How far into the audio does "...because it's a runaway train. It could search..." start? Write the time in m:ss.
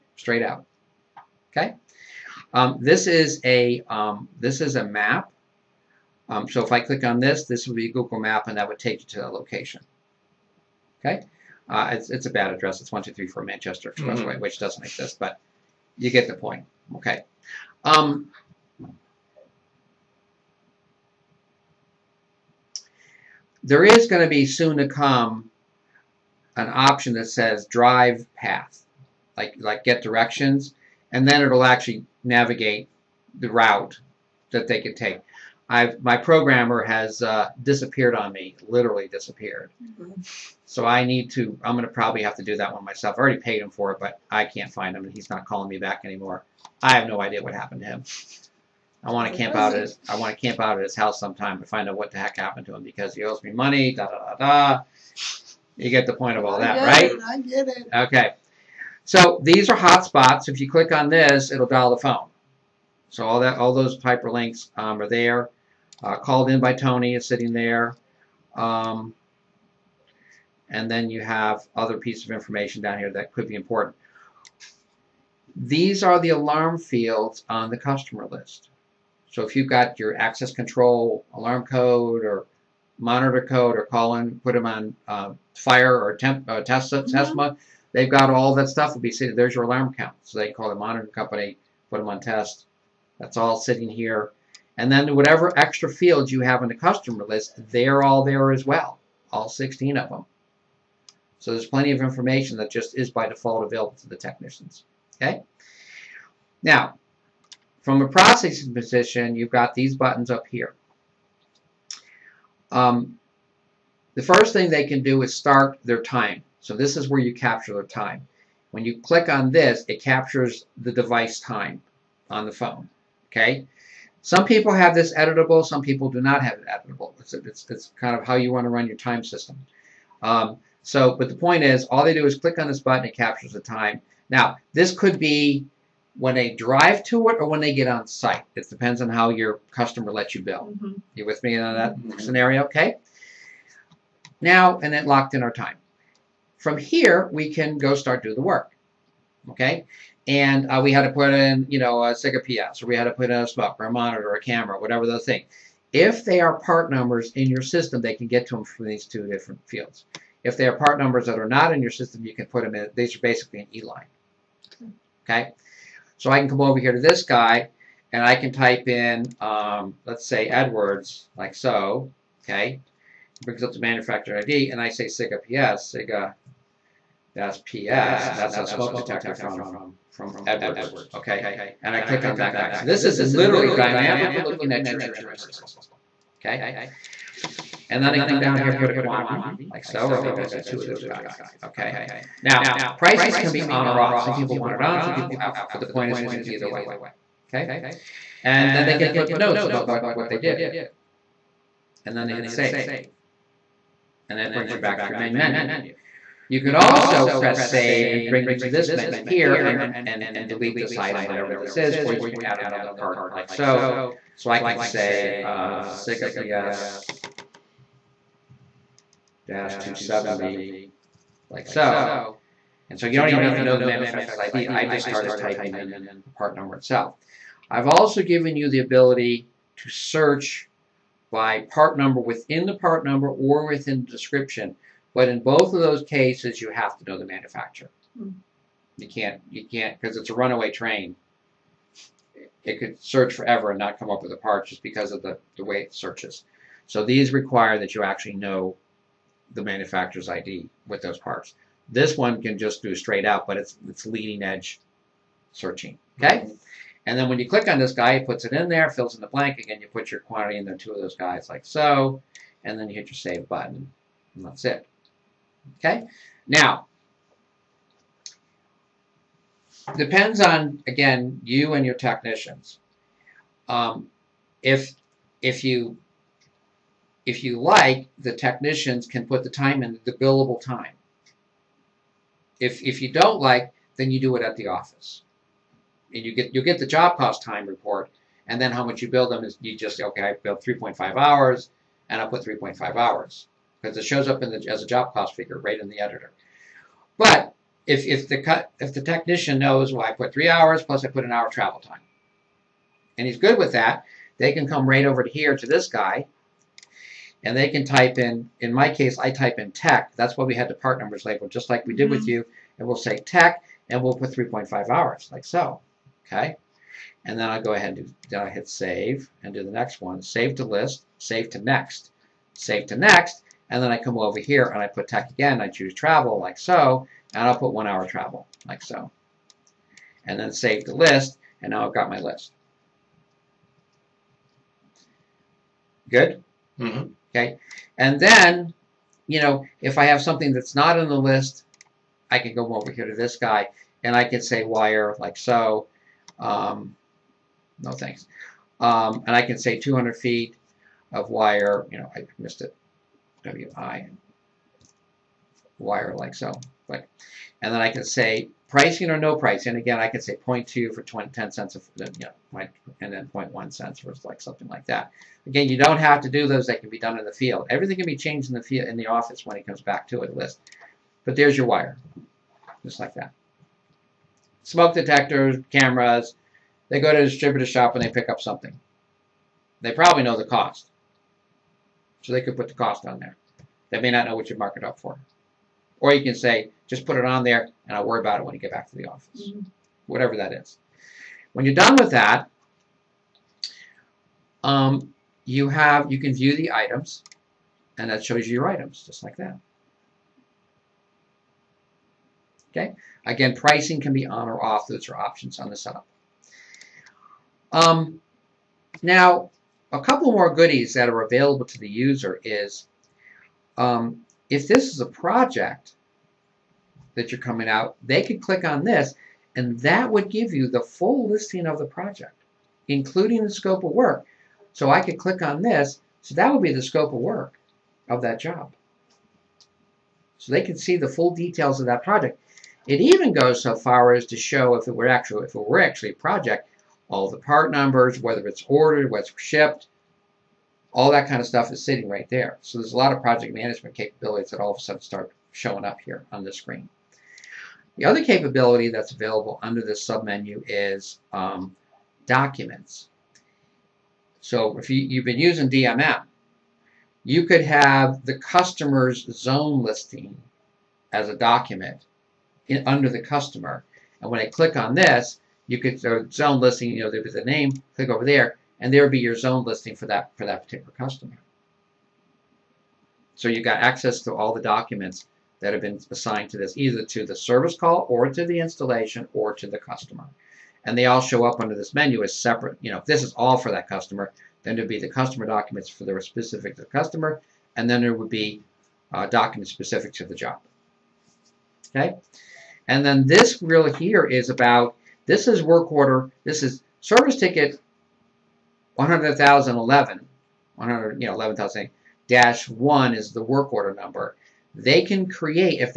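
4:00.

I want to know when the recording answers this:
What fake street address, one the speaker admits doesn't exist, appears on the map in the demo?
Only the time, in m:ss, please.
0:12.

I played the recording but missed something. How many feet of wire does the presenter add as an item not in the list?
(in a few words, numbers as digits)
200.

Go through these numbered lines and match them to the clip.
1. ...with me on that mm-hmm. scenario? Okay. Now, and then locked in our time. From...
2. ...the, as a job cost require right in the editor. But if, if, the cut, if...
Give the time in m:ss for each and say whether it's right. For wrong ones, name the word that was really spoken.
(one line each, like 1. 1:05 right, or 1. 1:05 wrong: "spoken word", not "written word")
1. 2:21 right
2. 4:54 wrong: "figure", not "require".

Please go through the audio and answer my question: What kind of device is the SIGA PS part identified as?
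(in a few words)
smoke detector.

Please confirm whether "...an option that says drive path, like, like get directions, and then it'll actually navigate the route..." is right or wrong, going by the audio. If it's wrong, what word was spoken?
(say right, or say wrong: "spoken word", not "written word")
right.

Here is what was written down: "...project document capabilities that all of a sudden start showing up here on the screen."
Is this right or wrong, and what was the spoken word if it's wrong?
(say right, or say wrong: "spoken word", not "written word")
wrong: "management", not "document".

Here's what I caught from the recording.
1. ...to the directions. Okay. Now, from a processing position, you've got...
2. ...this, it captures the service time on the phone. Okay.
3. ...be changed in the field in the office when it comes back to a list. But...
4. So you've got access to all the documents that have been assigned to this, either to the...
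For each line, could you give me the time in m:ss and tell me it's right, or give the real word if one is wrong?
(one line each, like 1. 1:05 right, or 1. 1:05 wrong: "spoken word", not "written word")
1. 1:44 wrong: "technicians", not "directions"
2. 1:59 wrong: "device", not "service"
3. 6:08 right
4. 7:53 right.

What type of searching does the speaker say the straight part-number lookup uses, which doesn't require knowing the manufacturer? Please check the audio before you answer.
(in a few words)
leading edge searching.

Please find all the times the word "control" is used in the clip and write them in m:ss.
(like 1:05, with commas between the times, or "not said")
1:20.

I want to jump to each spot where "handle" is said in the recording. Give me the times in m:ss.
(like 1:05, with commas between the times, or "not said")
not said.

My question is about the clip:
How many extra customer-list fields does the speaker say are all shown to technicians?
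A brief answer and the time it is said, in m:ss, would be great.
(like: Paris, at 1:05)
16, at 1:39.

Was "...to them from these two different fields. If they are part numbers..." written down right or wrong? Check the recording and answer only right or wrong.
right.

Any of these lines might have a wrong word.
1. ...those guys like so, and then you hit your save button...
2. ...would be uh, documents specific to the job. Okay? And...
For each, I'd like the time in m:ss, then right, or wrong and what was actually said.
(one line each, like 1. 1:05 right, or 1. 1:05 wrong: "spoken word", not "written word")
1. 4:21 right
2. 8:08 right.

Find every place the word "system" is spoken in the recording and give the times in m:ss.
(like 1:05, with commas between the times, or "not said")
2:09, 2:37, 2:41, 3:05.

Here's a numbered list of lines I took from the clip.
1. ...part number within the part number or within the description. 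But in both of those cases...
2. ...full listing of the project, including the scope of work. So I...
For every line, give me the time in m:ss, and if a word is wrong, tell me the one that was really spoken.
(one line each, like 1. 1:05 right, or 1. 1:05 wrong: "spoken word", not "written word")
1. 3:51 right
2. 7:00 right.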